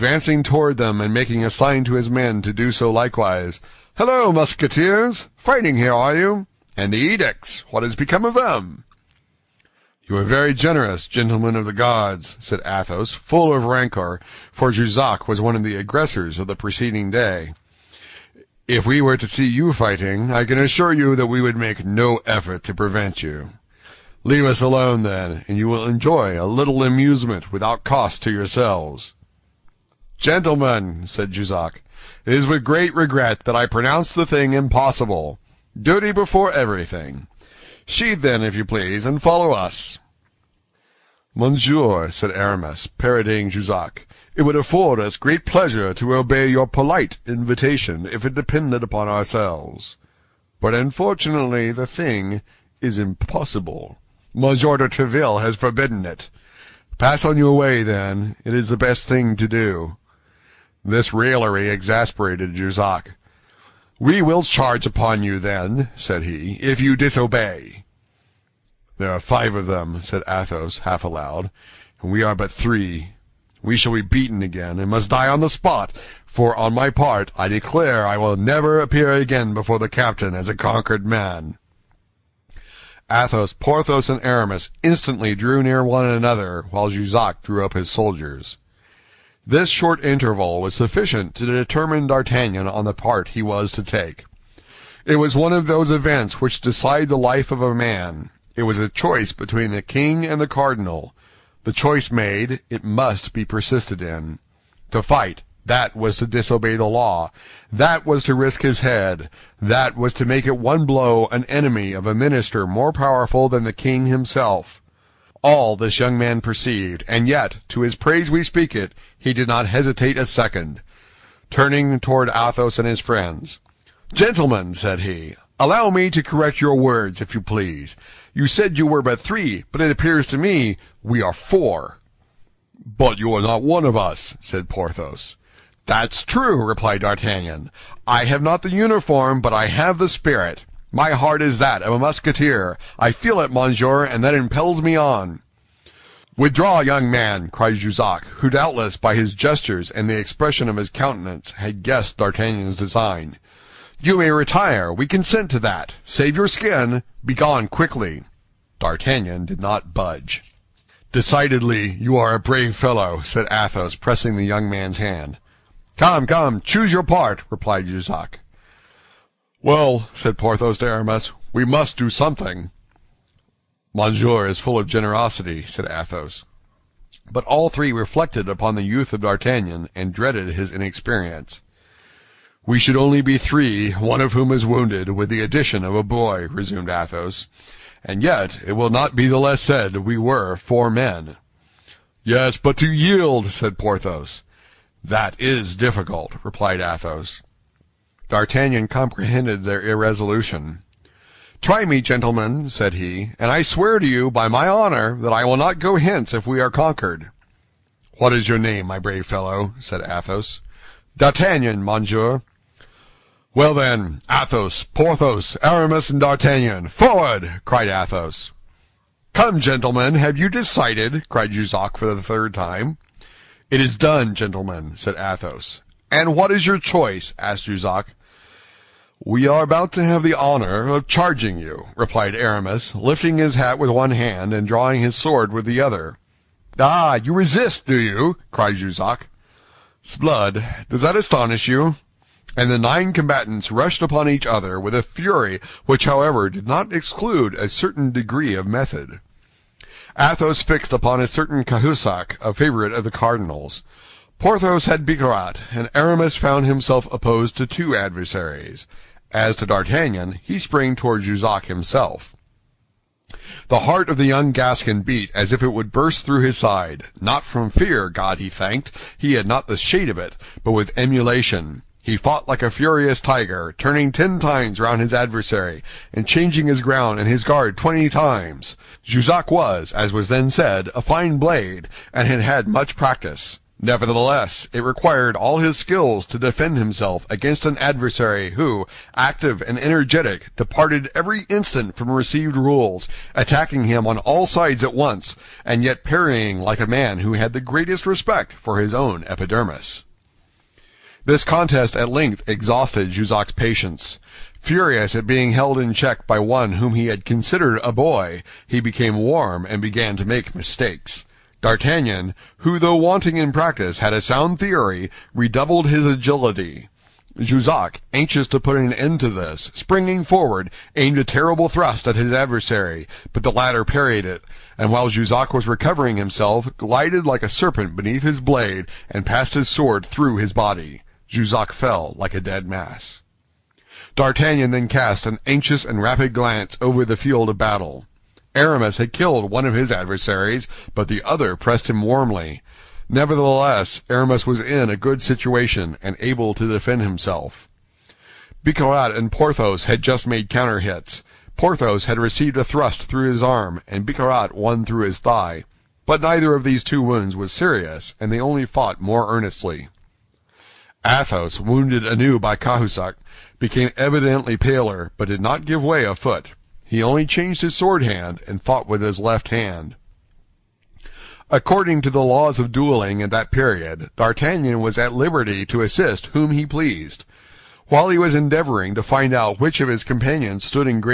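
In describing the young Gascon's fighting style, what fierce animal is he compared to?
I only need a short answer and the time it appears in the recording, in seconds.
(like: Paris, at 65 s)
A furious tiger, at 272 s.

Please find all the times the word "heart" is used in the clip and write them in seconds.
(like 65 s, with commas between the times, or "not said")
141 s, 263 s.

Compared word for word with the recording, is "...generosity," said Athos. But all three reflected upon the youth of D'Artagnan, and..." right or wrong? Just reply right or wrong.
right.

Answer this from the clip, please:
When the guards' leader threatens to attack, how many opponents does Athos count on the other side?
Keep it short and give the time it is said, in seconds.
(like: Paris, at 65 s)
5, at 69 s.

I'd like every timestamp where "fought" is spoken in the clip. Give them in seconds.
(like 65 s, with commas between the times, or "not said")
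272 s, 358 s, 368 s.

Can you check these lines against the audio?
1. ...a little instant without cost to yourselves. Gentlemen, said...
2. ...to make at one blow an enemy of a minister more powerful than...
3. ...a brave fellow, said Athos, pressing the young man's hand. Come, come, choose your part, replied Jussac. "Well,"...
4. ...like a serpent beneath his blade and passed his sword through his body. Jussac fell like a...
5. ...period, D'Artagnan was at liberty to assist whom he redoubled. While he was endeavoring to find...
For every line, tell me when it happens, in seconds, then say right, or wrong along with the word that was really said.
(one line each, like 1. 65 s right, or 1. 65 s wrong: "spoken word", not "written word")
1. 26 s wrong: "amusement", not "instant"
2. 110 s right
3. 162 s right
4. 327 s right
5. 373 s wrong: "pleased", not "redoubled".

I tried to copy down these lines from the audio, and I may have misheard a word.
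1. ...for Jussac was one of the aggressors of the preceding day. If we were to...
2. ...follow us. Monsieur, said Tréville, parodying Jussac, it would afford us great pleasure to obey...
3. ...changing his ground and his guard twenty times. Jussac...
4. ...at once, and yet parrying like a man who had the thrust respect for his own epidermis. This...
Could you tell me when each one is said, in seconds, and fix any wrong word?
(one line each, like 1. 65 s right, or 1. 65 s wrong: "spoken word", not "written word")
1. 14 s right
2. 39 s wrong: "Aramis", not "Tréville"
3. 276 s right
4. 294 s wrong: "greatest", not "thrust".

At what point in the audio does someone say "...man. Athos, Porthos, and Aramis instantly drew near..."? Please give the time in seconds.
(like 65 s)
81 s.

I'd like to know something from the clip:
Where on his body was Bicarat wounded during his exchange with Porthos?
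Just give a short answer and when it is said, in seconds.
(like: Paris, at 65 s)
His thigh, at 355 s.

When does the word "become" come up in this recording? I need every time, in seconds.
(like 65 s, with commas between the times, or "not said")
7 s.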